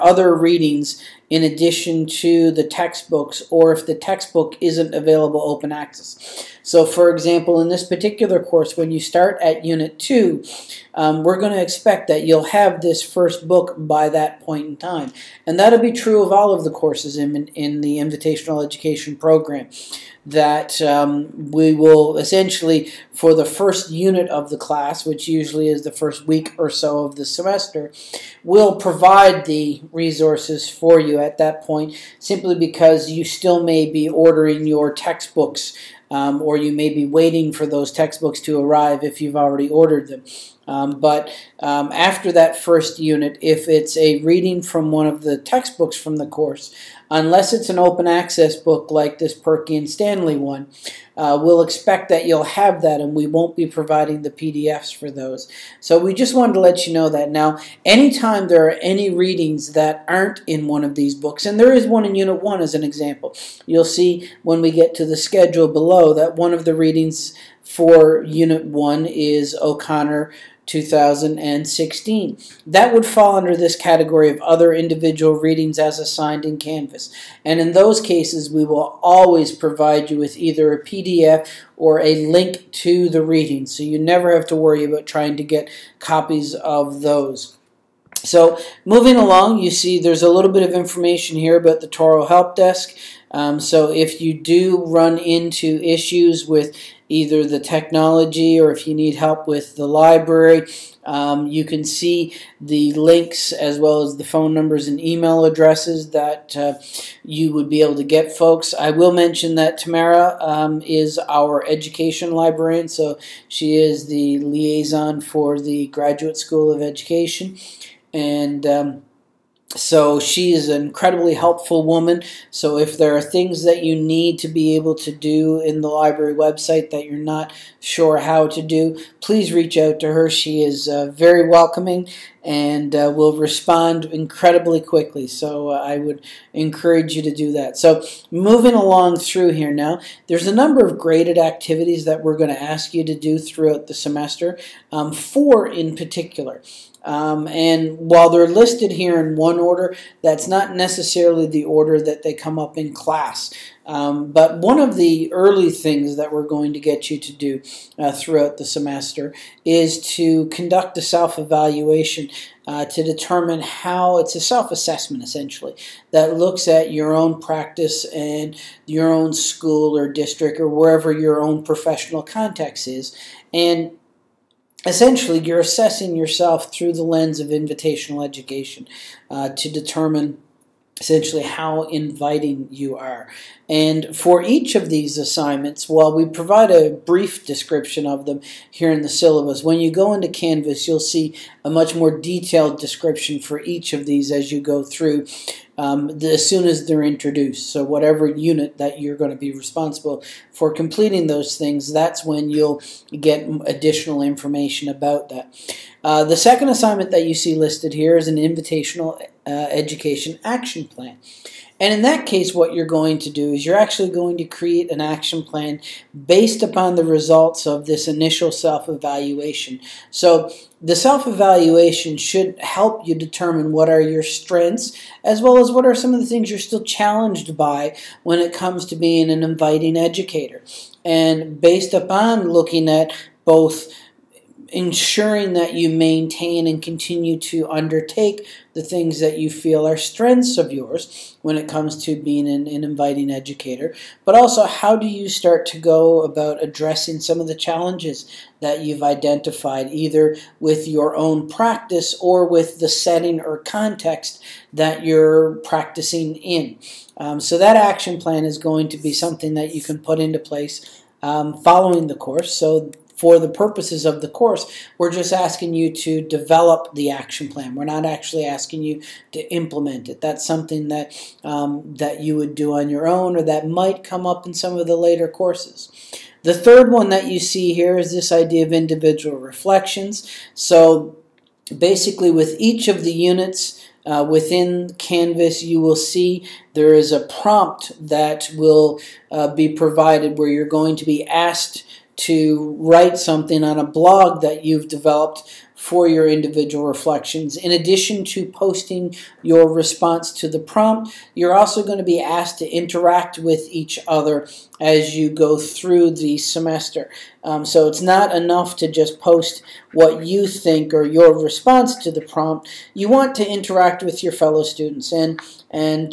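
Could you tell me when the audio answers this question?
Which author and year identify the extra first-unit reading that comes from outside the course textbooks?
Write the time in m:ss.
1:09.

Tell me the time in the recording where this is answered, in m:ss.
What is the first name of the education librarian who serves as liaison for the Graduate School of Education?
1:49.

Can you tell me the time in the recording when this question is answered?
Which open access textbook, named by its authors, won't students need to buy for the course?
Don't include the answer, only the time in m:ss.
0:49.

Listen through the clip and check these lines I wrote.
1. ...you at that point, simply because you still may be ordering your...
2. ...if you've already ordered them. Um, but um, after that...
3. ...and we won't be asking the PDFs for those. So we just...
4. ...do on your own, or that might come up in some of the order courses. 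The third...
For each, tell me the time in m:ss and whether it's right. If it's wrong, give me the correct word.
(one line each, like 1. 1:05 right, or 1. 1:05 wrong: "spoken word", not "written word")
1. 0:30 right
2. 0:39 right
3. 0:53 wrong: "providing", not "asking"
4. 4:32 wrong: "later", not "order".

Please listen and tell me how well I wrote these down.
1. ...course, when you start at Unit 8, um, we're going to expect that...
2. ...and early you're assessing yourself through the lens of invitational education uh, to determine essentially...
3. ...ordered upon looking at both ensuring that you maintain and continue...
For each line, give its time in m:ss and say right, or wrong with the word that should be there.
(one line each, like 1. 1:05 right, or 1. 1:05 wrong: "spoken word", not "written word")
1. 0:08 wrong: "2", not "8"
2. 2:53 wrong: "essentially", not "early"
3. 3:51 wrong: "based", not "ordered".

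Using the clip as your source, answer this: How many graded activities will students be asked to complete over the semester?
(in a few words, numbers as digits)
4.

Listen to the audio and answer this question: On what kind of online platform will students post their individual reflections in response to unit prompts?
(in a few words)
a blog.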